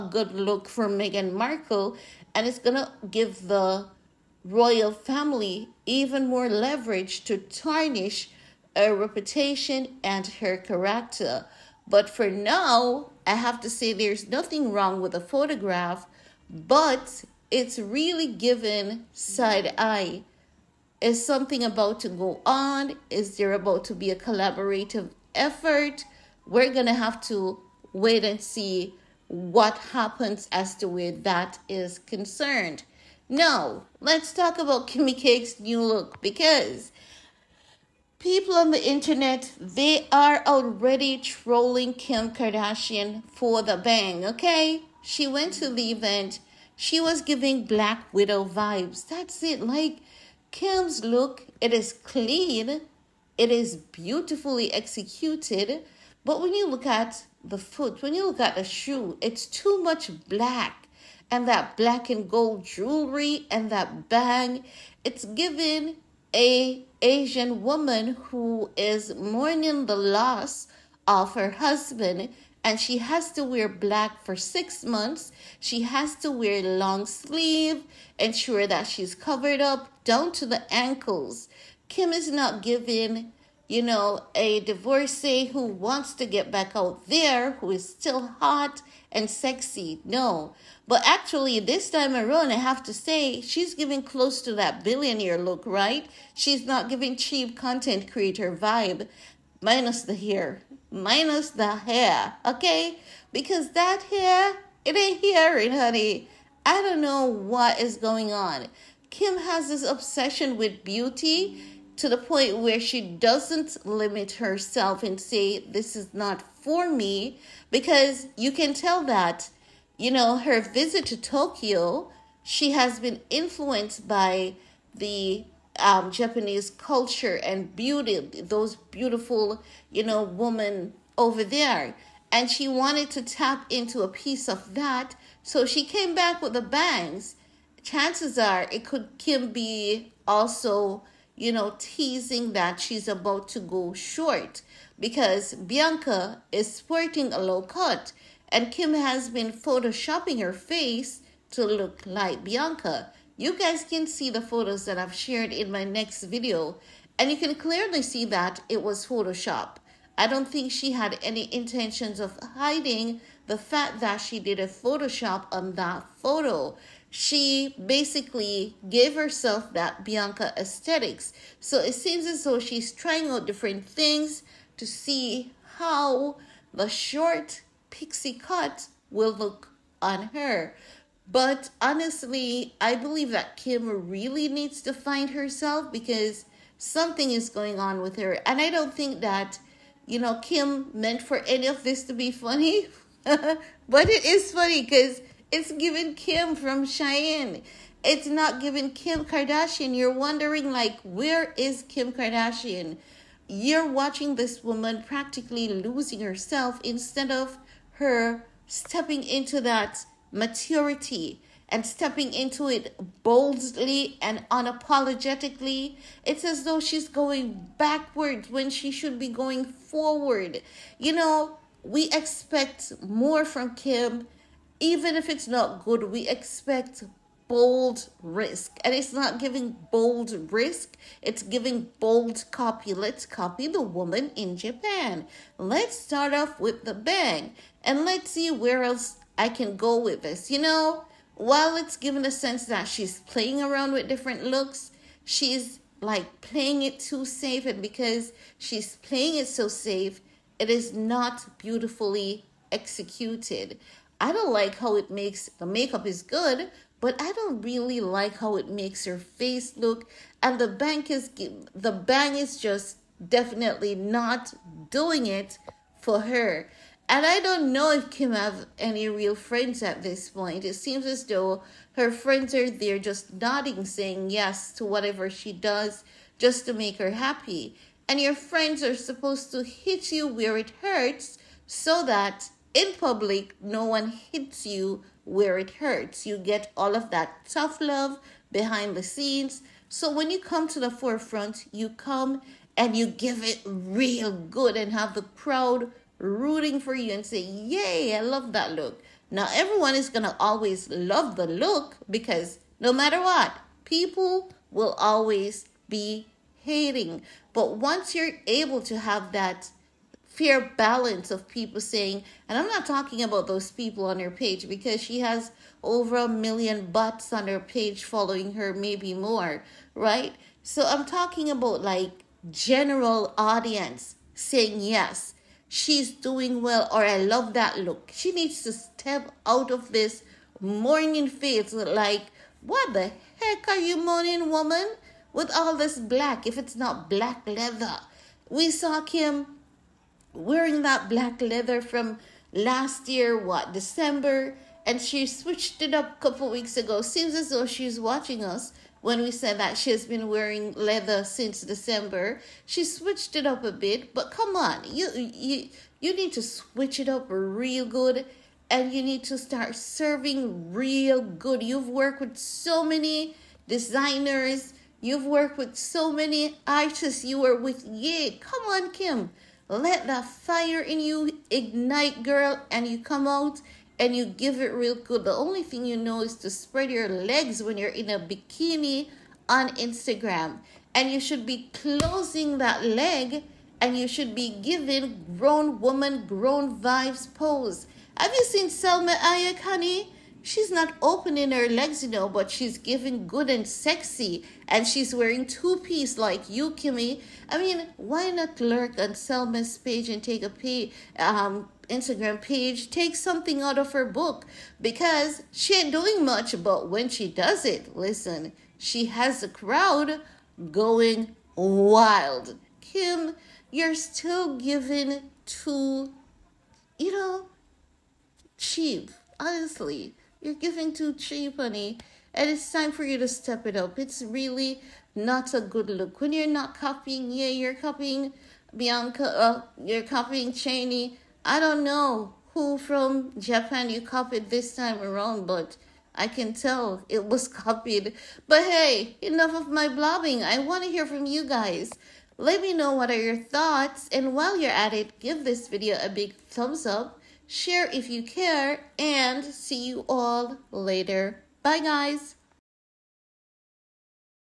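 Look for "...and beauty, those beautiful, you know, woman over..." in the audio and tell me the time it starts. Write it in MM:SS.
02:07.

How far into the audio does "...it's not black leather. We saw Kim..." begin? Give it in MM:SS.
05:36.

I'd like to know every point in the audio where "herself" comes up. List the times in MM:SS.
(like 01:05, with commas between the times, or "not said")
01:54, 02:49, 03:05, 03:26.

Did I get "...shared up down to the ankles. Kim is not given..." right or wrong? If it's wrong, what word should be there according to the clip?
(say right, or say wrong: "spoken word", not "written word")
wrong: "covered", not "shared".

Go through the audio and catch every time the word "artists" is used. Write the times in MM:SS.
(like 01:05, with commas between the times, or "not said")
06:06.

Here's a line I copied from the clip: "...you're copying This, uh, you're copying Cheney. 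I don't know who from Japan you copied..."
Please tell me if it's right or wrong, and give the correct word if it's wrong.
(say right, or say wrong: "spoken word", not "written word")
wrong: "Bianca", not "This".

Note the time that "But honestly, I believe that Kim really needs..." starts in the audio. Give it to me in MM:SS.
03:01.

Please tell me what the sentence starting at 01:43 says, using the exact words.
Because that hair, it ain't hearing, honey.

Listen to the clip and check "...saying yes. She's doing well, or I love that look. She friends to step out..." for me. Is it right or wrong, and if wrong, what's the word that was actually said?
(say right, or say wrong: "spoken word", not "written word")
wrong: "needs", not "friends".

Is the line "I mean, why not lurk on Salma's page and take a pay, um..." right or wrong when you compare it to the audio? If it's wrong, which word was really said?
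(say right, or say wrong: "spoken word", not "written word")
right.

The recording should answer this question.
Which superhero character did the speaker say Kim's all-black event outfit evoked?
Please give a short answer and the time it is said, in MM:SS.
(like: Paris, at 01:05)
Black Widow, at 00:47.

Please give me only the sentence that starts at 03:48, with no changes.
And it's not giving bold risk, it's giving bold copy.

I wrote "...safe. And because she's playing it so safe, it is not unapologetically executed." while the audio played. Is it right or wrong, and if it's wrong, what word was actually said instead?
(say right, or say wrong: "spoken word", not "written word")
wrong: "beautifully", not "unapologetically".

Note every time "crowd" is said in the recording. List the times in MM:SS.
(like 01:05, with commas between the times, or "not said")
04:55, 06:49.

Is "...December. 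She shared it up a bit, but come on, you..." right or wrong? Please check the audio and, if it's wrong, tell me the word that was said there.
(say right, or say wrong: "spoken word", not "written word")
wrong: "switched", not "shared".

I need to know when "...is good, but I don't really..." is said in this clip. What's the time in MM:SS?
04:16.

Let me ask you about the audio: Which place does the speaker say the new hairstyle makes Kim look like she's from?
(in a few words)
Cheyenne.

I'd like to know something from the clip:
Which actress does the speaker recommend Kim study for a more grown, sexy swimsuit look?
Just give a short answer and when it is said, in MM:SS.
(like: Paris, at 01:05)
Salma Hayek, at 06:28.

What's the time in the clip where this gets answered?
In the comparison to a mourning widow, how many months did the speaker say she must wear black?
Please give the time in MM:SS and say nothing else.
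01:14.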